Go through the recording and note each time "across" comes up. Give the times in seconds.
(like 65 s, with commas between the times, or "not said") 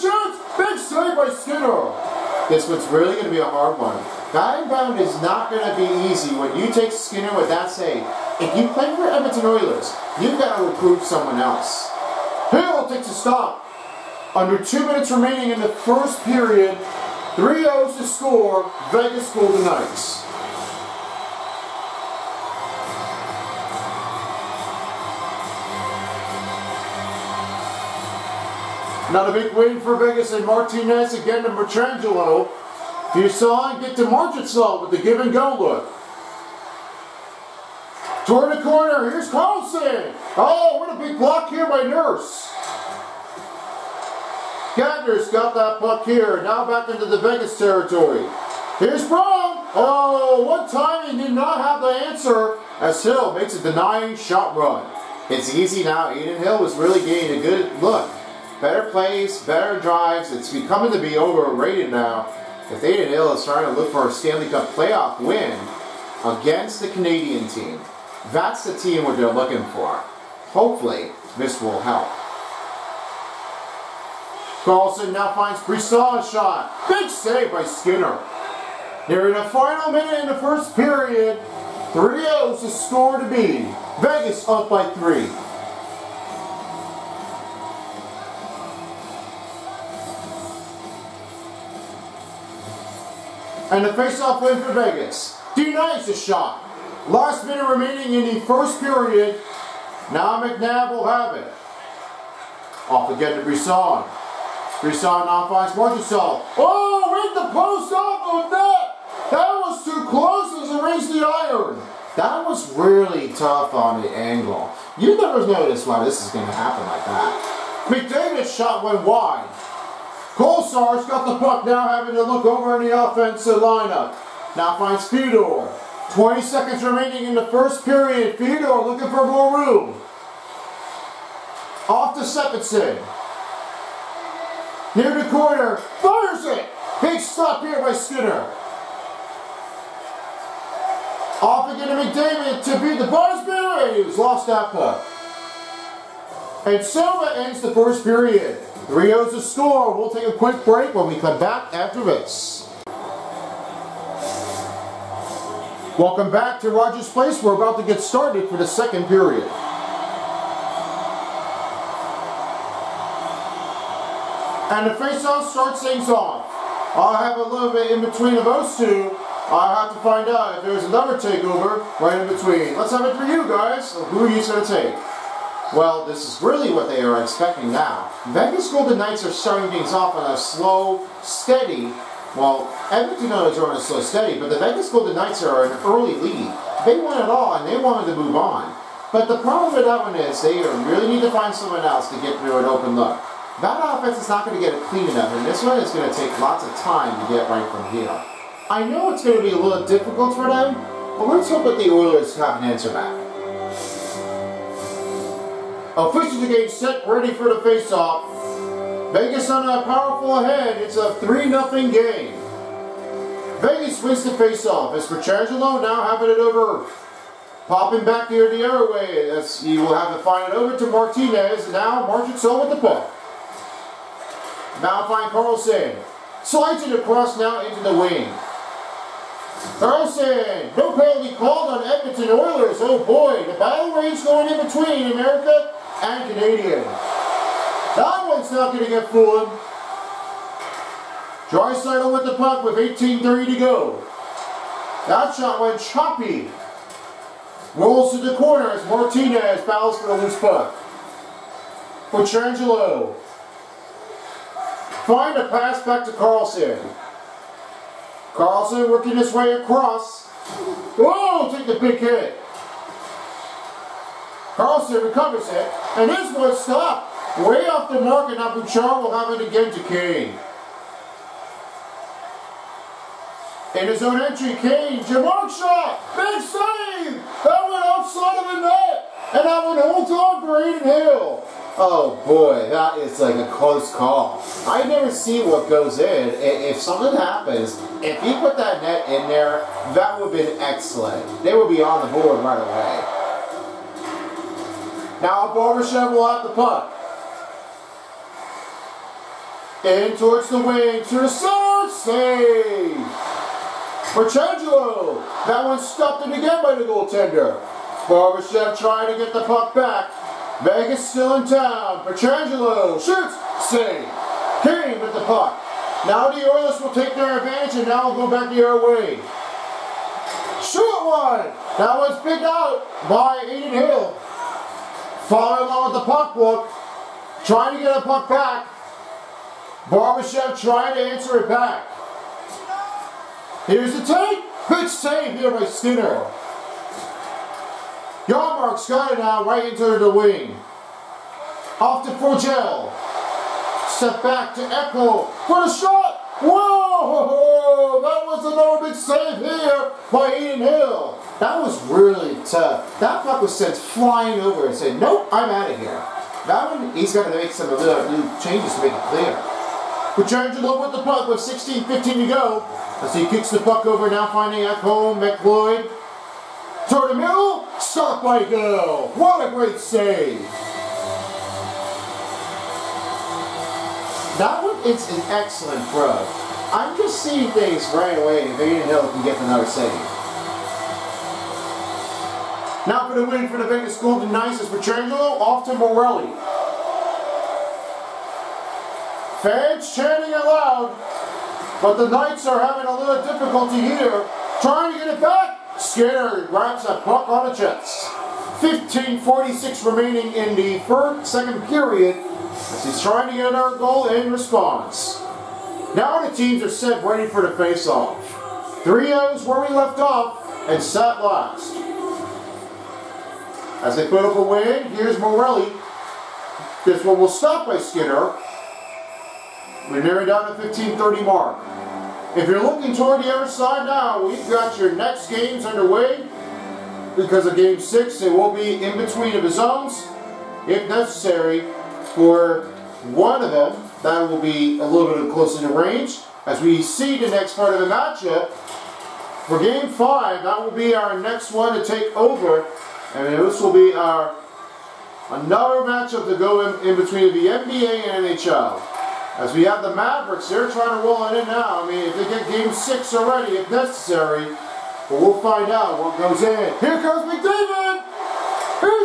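226 s, 259 s.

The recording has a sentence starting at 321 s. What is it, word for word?
That one's picked out by Adin Hill.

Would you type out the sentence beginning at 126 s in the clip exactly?
20 seconds remaining in the first period.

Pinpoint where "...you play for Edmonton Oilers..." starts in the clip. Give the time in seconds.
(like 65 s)
8 s.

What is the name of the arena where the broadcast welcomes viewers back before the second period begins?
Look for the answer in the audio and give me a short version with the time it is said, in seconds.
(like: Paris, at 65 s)
Rogers Place, at 156 s.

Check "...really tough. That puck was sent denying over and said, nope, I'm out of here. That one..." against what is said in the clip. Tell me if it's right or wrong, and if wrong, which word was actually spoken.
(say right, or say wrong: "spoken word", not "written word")
wrong: "flying", not "denying".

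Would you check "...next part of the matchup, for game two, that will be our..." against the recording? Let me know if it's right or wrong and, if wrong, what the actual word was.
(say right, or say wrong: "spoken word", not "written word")
wrong: "five", not "two".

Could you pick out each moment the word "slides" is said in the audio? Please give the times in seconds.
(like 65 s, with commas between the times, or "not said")
226 s.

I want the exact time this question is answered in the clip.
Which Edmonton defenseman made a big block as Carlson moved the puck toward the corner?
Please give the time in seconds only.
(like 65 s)
41 s.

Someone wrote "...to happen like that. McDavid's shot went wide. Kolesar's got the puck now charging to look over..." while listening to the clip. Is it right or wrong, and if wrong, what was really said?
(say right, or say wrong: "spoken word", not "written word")
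wrong: "having", not "charging".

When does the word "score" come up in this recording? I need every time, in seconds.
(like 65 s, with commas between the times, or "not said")
18 s, 82 s, 149 s.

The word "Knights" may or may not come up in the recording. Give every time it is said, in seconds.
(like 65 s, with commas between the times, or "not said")
19 s, 178 s, 185 s, 392 s.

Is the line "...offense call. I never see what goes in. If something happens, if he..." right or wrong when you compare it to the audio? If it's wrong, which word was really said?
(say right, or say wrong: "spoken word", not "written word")
wrong: "close", not "offense".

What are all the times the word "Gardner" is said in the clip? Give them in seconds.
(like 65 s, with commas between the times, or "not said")
44 s.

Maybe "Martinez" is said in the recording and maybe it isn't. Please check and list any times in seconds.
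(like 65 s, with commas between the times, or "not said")
30 s, 220 s, 248 s.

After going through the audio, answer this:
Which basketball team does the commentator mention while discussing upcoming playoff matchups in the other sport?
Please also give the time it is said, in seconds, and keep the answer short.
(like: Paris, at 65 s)
Mavericks, at 449 s.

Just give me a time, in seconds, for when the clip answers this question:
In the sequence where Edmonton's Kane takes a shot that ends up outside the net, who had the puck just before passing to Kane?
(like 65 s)
268 s.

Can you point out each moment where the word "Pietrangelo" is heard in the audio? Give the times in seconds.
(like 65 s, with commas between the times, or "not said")
215 s, 252 s, 312 s, 384 s.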